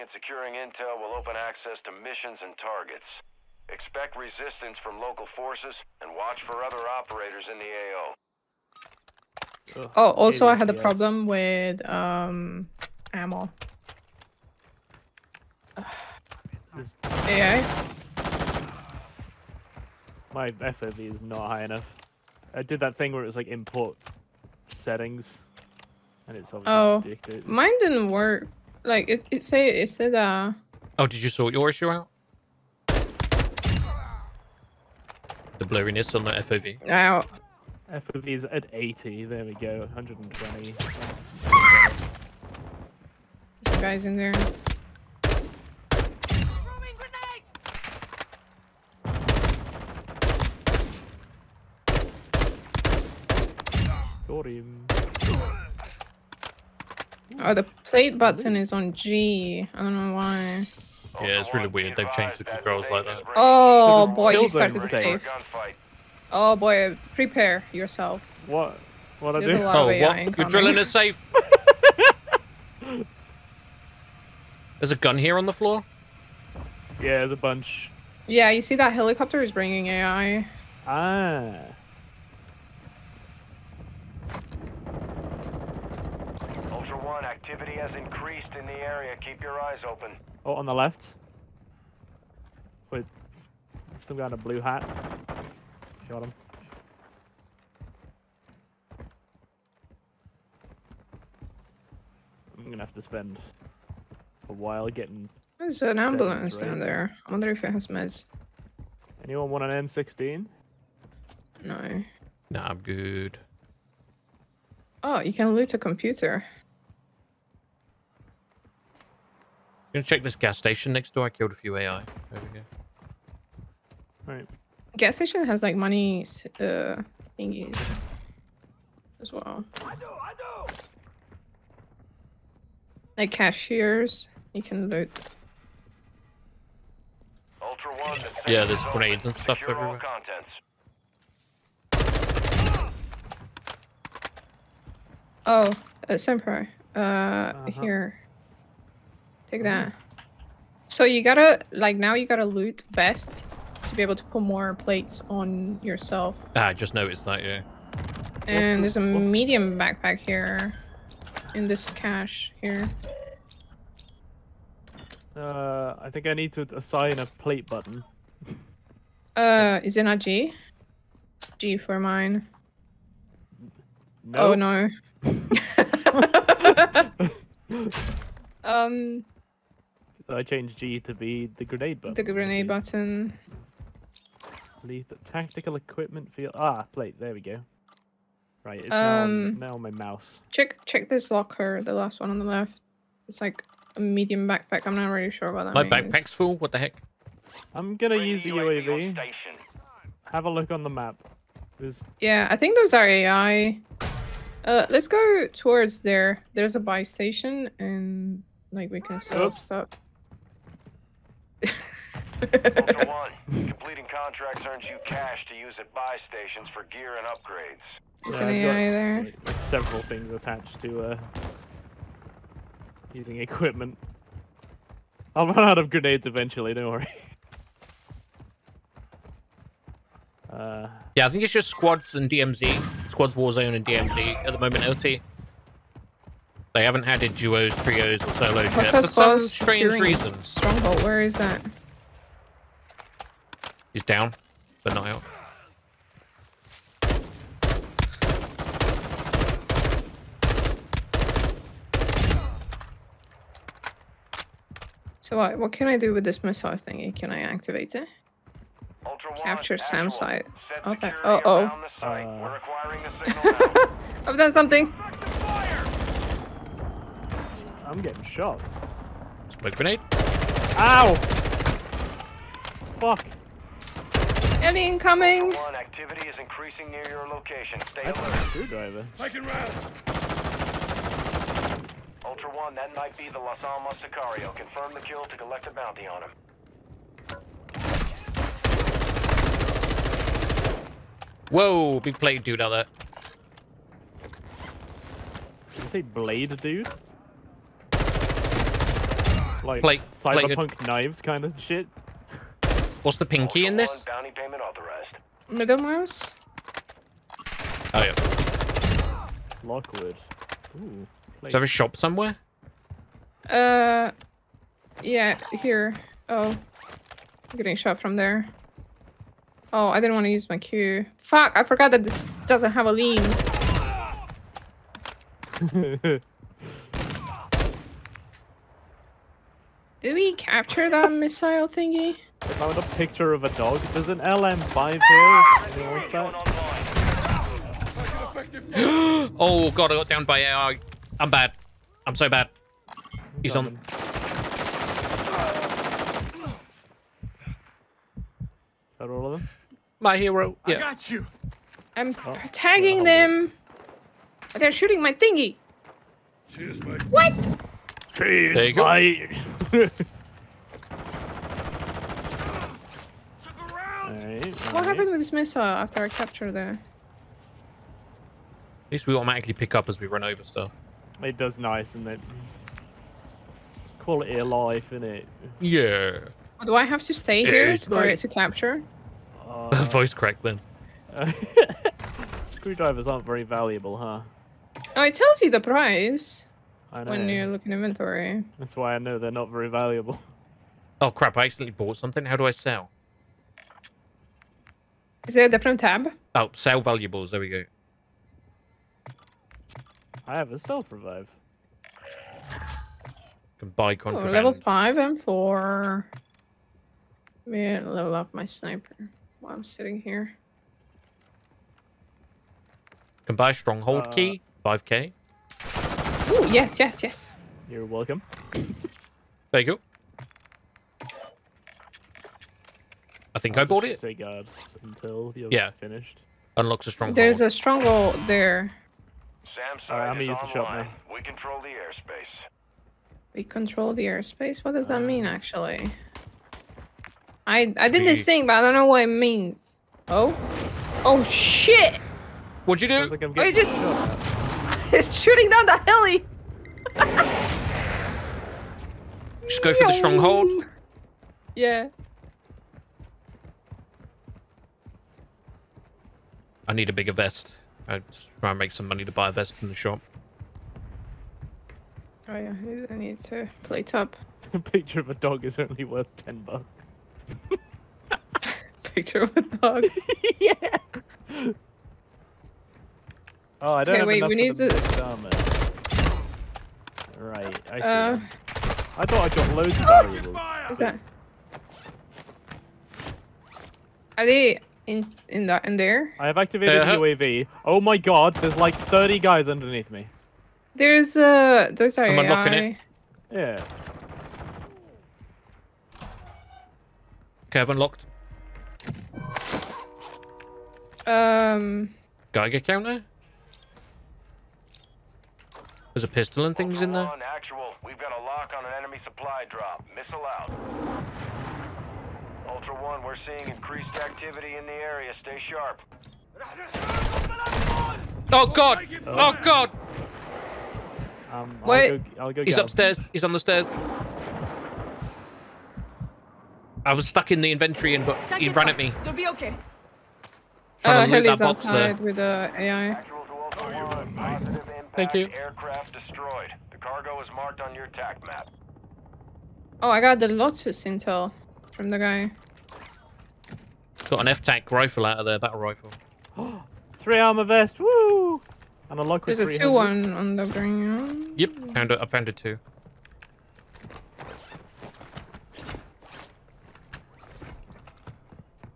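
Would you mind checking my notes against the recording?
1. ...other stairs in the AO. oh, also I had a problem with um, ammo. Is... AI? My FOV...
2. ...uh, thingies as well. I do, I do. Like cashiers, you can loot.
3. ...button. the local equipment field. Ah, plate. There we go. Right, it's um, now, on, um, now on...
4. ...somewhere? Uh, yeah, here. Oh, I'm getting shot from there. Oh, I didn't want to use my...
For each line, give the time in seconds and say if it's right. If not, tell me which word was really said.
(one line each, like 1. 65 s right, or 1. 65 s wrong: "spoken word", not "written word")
1. 6 s wrong: "operators", not "stairs"
2. 126 s right
3. 182 s wrong: "tactical", not "local"
4. 311 s right.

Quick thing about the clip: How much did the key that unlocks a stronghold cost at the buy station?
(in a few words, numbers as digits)
5k.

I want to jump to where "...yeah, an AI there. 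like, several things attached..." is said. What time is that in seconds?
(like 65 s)
218 s.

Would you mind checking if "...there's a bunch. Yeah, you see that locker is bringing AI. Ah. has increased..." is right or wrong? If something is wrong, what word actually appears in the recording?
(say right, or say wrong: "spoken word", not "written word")
wrong: "helicopter", not "locker".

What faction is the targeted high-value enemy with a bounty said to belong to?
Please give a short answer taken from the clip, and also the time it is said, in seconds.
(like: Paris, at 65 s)
Las Almas Sicario, at 283 s.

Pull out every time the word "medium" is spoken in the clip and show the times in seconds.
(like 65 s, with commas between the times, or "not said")
158 s, 193 s.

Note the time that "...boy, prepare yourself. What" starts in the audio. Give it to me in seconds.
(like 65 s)
66 s.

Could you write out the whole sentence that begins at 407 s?
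Let me level up my sniper while I'm sitting here.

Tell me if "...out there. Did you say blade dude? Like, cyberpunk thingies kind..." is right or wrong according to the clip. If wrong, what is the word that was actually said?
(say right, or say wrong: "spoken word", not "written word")
wrong: "knives", not "thingies".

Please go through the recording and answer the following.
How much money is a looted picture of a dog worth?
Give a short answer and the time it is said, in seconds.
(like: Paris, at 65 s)
10 bucks, at 466 s.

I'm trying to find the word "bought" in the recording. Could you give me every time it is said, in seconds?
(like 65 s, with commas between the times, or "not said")
391 s, 423 s.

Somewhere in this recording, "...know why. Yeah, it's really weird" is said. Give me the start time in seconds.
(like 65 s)
60 s.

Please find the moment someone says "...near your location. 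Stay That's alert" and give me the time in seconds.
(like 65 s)
276 s.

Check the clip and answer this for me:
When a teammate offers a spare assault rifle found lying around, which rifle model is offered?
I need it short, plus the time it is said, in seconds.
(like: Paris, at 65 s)
M16, at 109 s.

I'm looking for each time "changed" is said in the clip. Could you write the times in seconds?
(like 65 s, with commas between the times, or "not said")
62 s, 180 s.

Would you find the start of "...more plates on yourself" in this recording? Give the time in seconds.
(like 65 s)
154 s.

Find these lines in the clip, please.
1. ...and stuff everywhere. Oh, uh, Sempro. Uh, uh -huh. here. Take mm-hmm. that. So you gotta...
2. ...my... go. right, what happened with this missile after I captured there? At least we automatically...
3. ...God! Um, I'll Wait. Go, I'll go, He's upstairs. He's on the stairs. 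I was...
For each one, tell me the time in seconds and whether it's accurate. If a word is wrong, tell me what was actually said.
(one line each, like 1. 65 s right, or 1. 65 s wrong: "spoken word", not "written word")
1. 139 s right
2. 358 s right
3. 519 s right.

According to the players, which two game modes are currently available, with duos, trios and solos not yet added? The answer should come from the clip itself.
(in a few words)
Warzone and DMZ.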